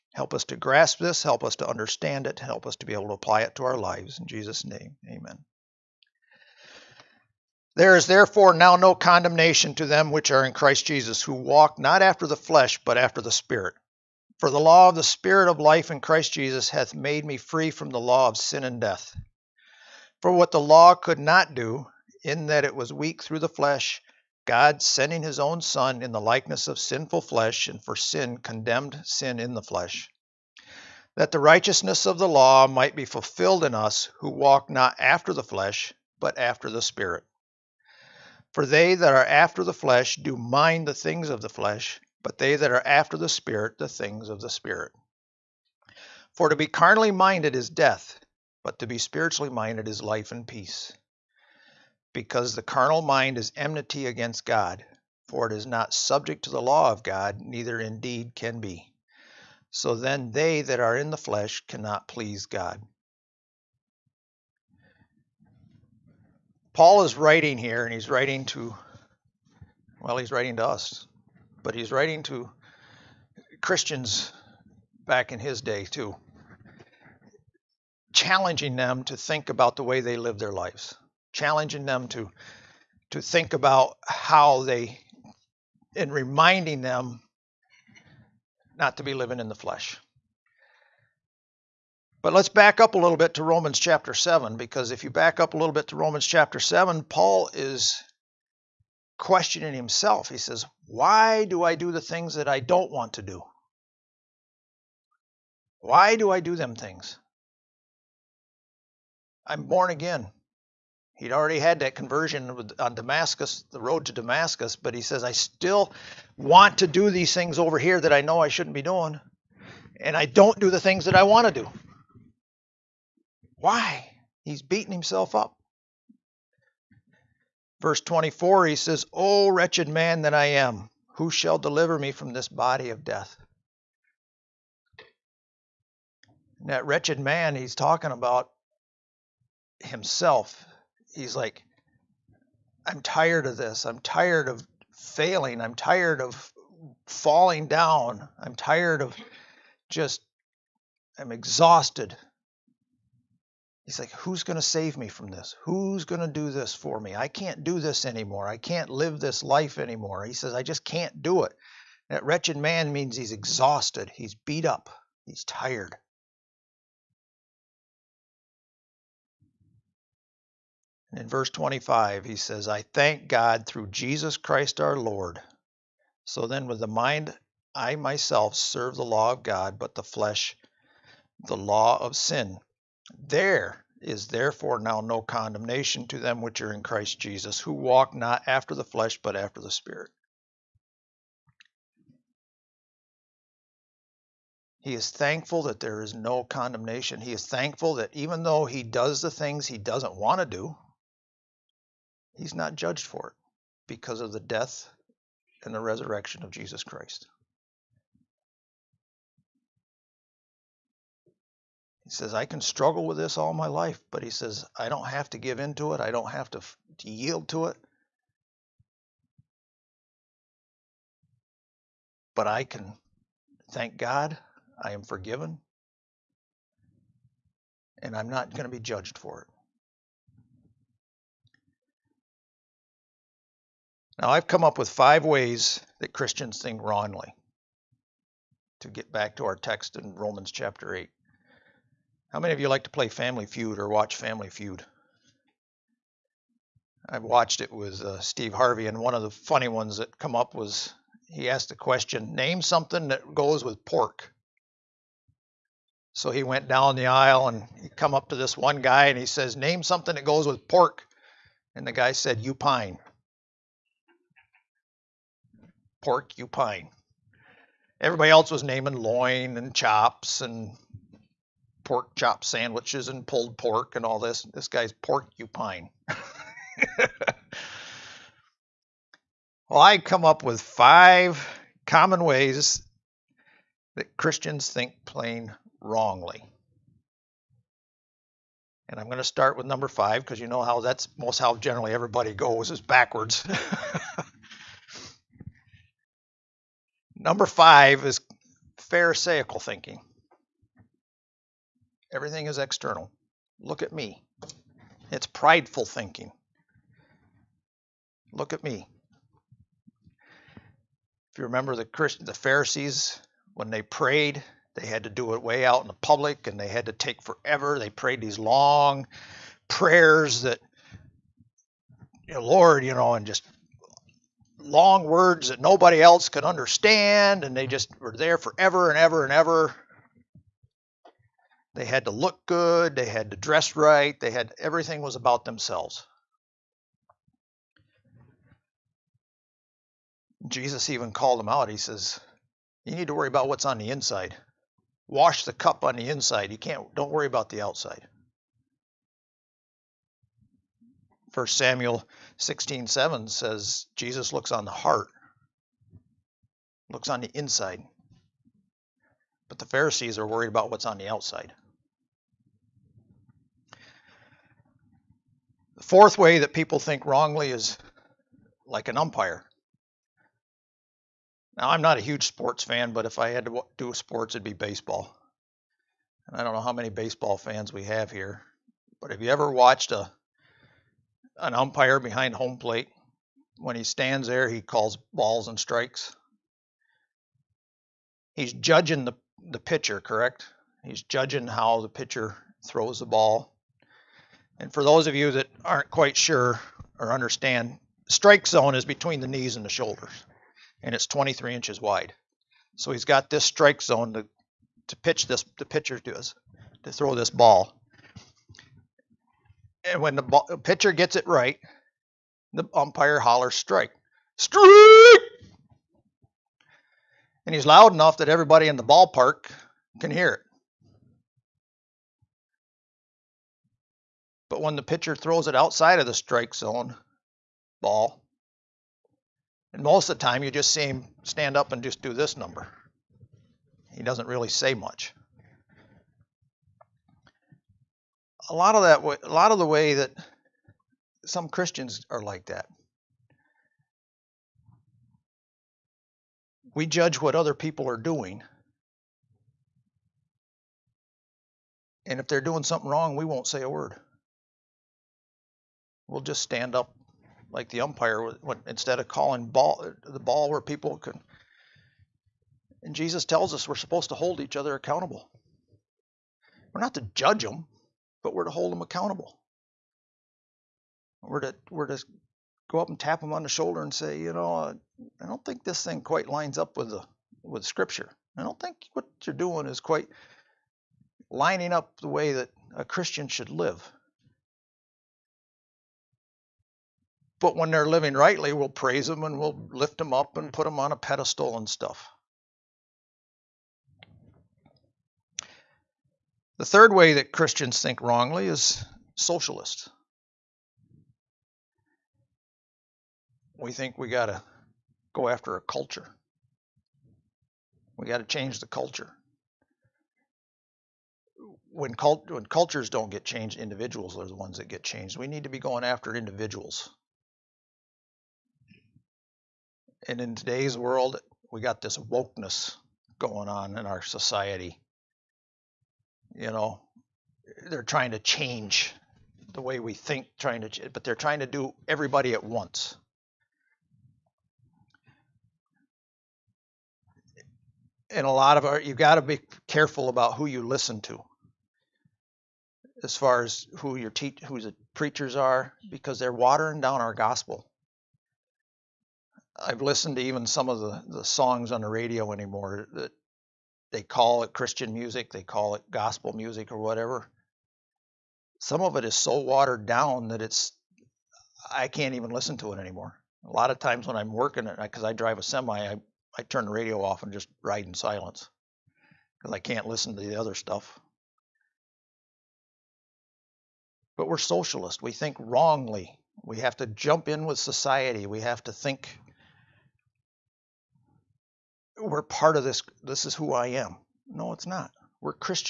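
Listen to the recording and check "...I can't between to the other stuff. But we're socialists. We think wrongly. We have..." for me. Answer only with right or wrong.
wrong.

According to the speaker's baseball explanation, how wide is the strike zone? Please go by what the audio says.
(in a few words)
23 inches.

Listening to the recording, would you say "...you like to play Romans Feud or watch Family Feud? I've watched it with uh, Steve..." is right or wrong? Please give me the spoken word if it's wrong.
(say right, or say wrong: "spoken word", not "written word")
wrong: "Family", not "Romans".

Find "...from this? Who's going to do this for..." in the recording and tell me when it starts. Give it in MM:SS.
02:35.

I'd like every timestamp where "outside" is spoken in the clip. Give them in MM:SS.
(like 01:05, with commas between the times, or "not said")
05:47, 06:01, 07:05.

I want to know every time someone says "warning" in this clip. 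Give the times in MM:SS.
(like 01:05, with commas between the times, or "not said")
not said.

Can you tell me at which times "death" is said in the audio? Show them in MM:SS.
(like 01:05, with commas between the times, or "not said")
00:18, 00:47, 02:13, 03:24.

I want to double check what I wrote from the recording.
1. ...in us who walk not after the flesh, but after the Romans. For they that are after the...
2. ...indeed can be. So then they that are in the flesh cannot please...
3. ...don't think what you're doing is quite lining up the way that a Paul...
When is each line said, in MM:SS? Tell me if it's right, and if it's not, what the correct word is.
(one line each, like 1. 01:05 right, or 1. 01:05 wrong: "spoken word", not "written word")
1. 00:33 wrong: "Spirit", not "Romans"
2. 00:57 right
3. 07:58 wrong: "Christian", not "Paul".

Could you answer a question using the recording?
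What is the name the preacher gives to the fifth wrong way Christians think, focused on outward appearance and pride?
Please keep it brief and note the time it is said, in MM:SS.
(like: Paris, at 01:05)
Pharisaical thinking, at 04:58.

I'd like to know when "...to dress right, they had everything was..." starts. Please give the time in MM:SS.
05:33.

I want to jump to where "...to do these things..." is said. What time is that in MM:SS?
01:56.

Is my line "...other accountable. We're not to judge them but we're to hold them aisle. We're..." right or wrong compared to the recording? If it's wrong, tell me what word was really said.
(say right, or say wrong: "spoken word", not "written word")
wrong: "accountable", not "aisle".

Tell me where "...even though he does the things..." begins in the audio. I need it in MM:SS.
03:18.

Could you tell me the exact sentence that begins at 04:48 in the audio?
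And I'm going to start with number five because you know how that's most how generally everybody goes is backwards.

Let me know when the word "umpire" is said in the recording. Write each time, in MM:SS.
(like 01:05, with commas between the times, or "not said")
06:08, 06:21, 06:52, 07:37.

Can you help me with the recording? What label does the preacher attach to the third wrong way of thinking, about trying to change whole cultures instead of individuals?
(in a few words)
Socialist.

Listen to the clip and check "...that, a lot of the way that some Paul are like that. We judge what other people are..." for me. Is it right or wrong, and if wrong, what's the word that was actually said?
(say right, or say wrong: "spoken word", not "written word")
wrong: "Christians", not "Paul".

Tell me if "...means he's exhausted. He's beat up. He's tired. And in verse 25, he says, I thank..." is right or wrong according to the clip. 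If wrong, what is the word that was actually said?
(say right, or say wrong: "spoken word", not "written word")
right.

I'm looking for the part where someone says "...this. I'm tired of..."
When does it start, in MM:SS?
02:23.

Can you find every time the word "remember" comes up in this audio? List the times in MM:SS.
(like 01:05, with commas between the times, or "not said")
05:11.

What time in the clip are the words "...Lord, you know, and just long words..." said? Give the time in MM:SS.
05:22.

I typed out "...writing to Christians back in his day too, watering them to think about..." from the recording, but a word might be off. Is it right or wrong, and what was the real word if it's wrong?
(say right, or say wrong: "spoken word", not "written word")
wrong: "challenging", not "watering".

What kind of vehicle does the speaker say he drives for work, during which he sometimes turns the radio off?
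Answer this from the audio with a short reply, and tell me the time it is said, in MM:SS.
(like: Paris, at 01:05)
A semi, at 09:25.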